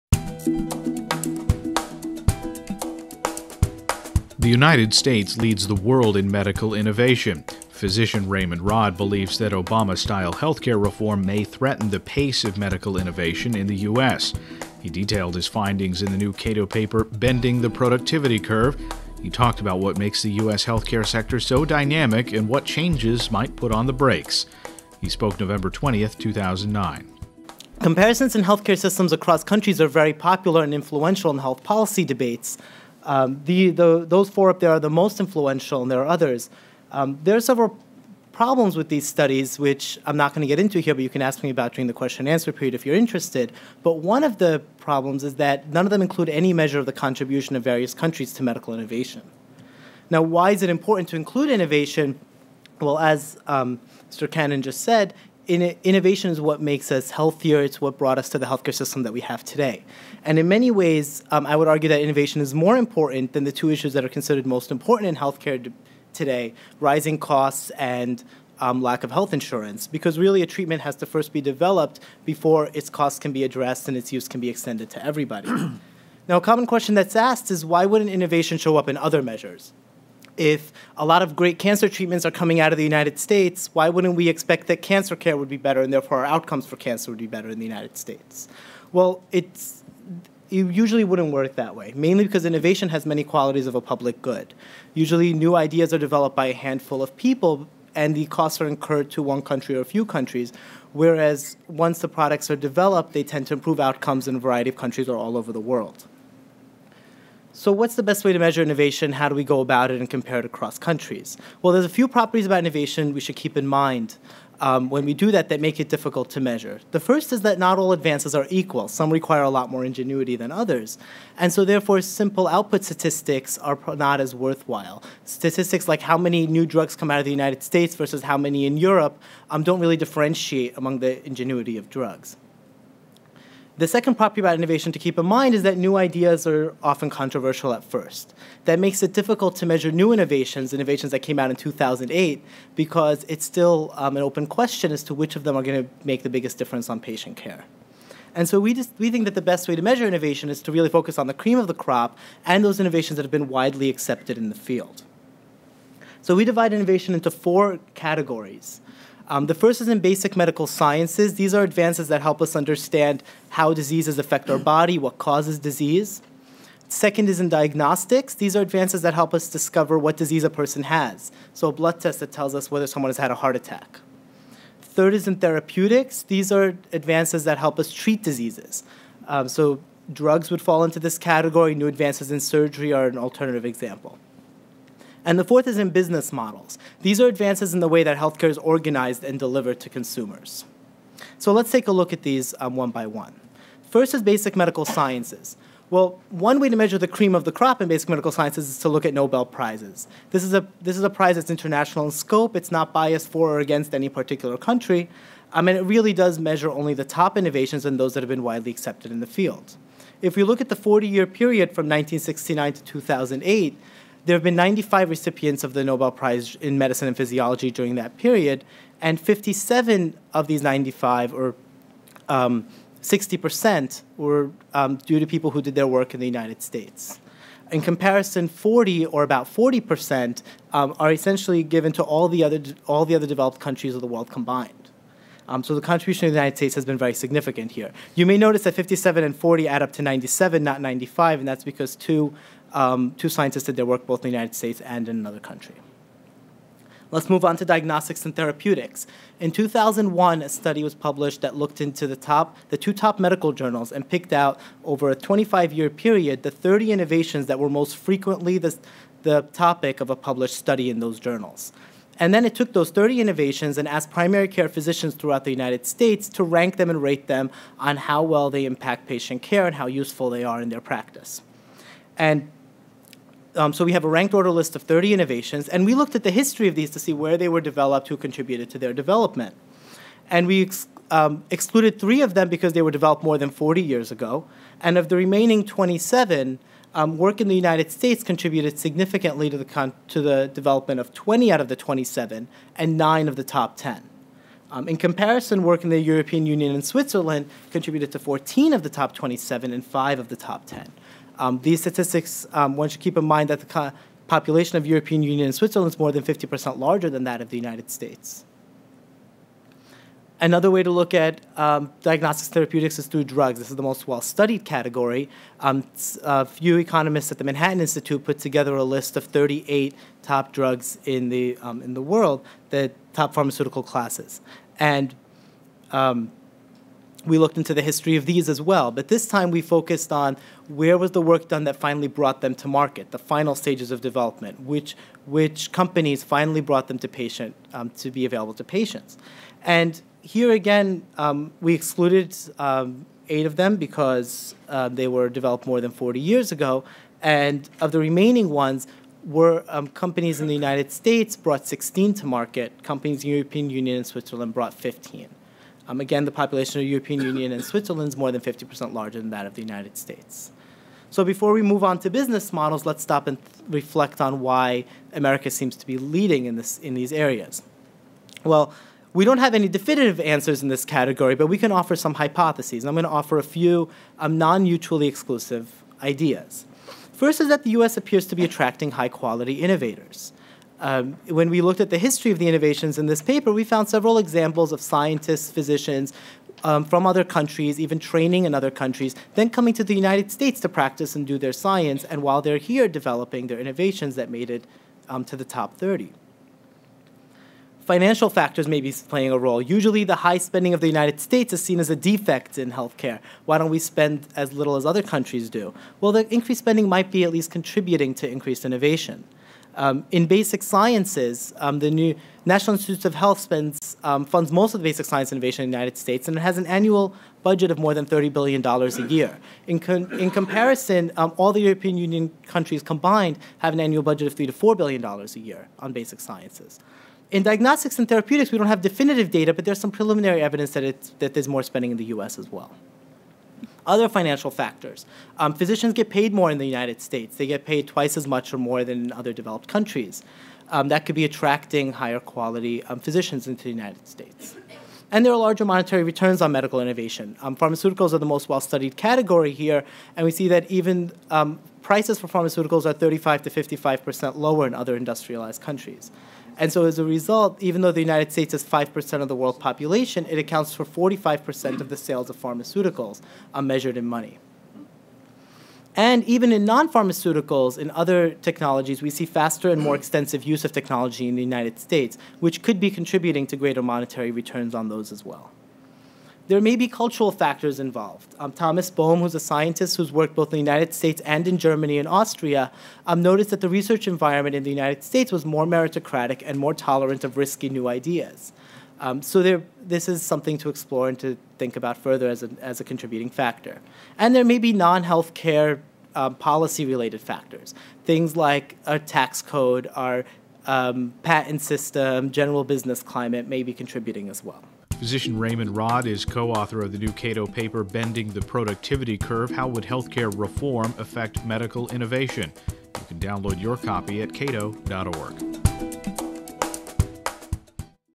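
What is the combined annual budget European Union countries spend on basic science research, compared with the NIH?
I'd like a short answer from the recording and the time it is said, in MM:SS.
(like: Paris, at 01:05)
$3 to $4 billion, at 07:04.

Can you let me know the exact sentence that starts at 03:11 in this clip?
So let's take a look at these um, one by one.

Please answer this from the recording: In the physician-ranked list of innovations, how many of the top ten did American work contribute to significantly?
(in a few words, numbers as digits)
9.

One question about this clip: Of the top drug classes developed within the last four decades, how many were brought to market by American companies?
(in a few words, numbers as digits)
16.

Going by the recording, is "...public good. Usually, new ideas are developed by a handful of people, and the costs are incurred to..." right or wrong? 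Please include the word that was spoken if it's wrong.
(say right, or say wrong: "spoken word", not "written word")
right.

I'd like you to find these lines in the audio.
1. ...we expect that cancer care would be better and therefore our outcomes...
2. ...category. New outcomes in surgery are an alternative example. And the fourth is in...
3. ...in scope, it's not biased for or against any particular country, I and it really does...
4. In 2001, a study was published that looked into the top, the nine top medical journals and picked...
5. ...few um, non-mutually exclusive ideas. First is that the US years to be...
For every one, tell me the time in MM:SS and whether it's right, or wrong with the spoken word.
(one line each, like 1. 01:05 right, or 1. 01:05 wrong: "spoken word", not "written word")
1. 01:24 right
2. 03:01 wrong: "advances", not "outcomes"
3. 03:22 right
4. 04:09 wrong: "two", not "nine"
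5. 06:13 wrong: "appears", not "years".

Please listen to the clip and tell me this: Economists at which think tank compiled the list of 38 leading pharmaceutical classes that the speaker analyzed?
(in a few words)
Manhattan Institute.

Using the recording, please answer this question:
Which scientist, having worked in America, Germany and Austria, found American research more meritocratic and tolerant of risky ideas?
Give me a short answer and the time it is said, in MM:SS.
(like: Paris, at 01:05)
Thomas Bohm, at 07:58.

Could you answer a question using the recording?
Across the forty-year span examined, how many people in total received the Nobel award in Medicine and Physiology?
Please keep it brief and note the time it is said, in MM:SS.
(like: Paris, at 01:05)
95, at 03:34.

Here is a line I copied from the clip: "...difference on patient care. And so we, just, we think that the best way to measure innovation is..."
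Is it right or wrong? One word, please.
right.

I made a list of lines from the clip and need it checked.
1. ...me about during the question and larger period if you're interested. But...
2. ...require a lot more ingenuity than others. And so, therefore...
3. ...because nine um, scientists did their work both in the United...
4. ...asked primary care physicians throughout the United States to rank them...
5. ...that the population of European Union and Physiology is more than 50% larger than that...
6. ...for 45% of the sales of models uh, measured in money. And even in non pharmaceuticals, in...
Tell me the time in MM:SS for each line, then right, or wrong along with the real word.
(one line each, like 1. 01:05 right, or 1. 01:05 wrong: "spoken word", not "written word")
1. 00:41 wrong: "answer", not "larger"
2. 01:59 right
3. 04:01 wrong: "two", not "nine"
4. 04:23 right
5. 05:03 wrong: "Switzerland", not "Physiology"
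6. 07:40 wrong: "pharmaceuticals", not "models".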